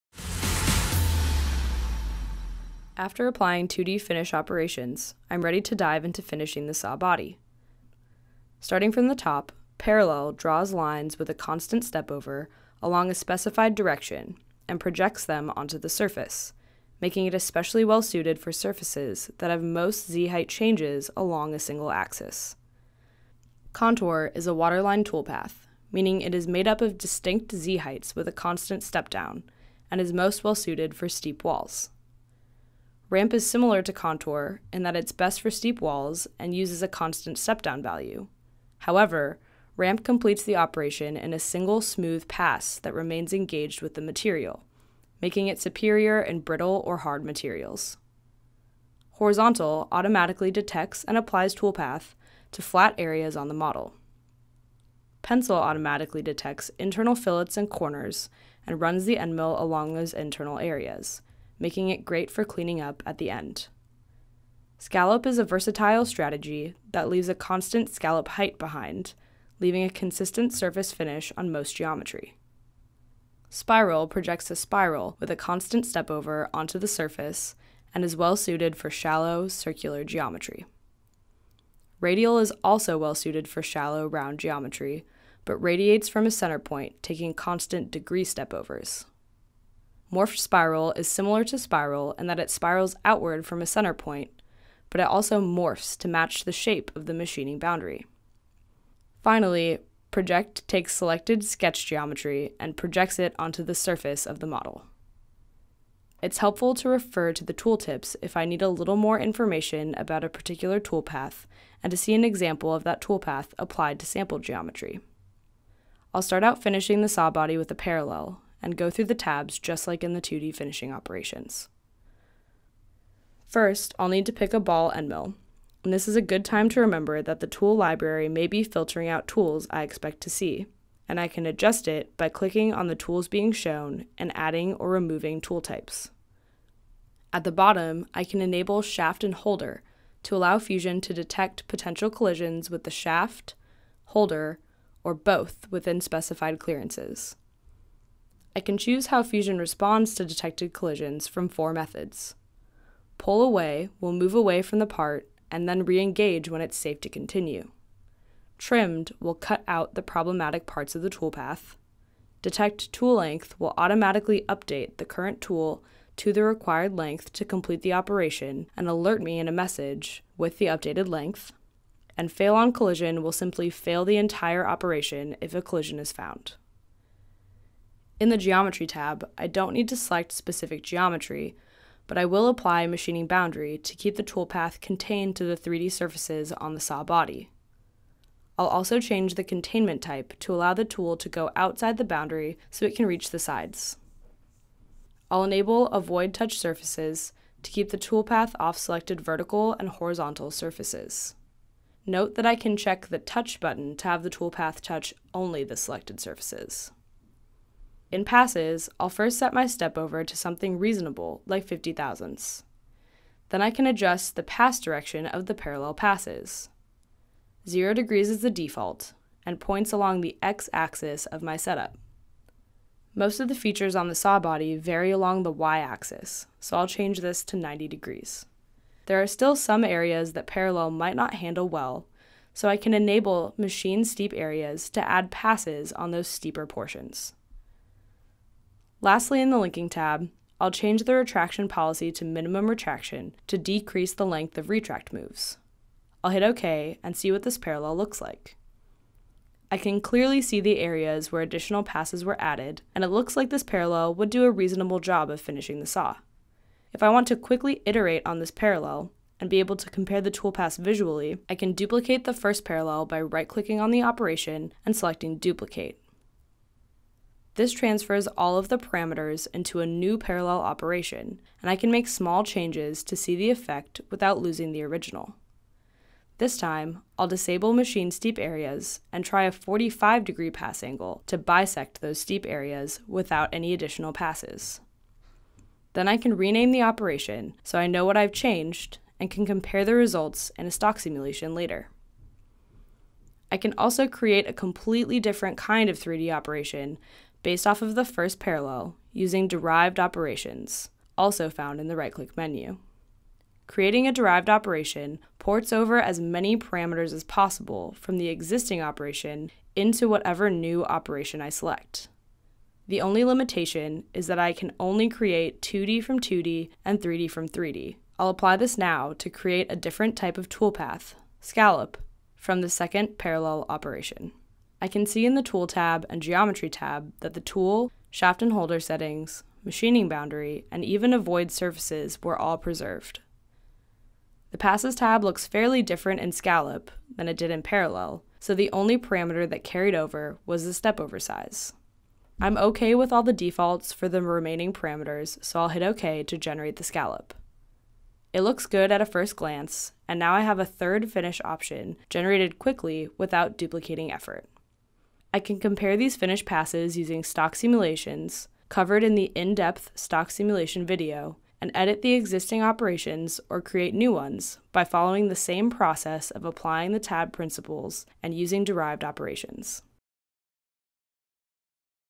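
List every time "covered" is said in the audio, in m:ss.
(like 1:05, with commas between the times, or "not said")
5:58.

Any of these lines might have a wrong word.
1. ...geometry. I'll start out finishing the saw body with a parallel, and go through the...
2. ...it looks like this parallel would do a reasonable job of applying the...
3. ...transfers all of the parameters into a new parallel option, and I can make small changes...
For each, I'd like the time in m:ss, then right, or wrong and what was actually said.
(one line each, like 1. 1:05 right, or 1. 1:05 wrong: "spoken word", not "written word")
1. 1:54 right
2. 4:13 wrong: "finishing", not "applying"
3. 4:27 wrong: "operation", not "option".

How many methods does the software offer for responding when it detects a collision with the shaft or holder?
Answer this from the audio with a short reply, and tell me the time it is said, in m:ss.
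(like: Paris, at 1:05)
4, at 2:31.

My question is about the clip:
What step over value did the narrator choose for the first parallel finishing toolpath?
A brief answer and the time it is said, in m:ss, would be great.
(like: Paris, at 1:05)
50 thousandths, at 3:31.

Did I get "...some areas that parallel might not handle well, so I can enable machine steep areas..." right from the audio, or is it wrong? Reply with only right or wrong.
right.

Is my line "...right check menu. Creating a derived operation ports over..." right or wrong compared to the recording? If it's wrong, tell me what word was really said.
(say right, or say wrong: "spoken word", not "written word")
wrong: "click", not "check".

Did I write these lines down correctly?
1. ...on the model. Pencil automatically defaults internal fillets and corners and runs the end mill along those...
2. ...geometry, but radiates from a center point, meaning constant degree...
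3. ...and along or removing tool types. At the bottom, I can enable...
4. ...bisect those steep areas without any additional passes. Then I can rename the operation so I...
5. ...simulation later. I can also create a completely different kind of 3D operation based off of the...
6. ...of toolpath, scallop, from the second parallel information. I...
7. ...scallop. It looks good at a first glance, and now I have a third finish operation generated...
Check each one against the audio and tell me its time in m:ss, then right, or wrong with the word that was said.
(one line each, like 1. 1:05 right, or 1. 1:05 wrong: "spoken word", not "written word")
1. 0:53 wrong: "detects", not "defaults"
2. 1:24 wrong: "taking", not "meaning"
3. 2:14 wrong: "adding", not "along"
4. 4:41 right
5. 4:50 right
6. 5:20 wrong: "operation", not "information"
7. 5:46 wrong: "option", not "operation".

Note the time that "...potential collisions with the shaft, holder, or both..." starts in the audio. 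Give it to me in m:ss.
2:21.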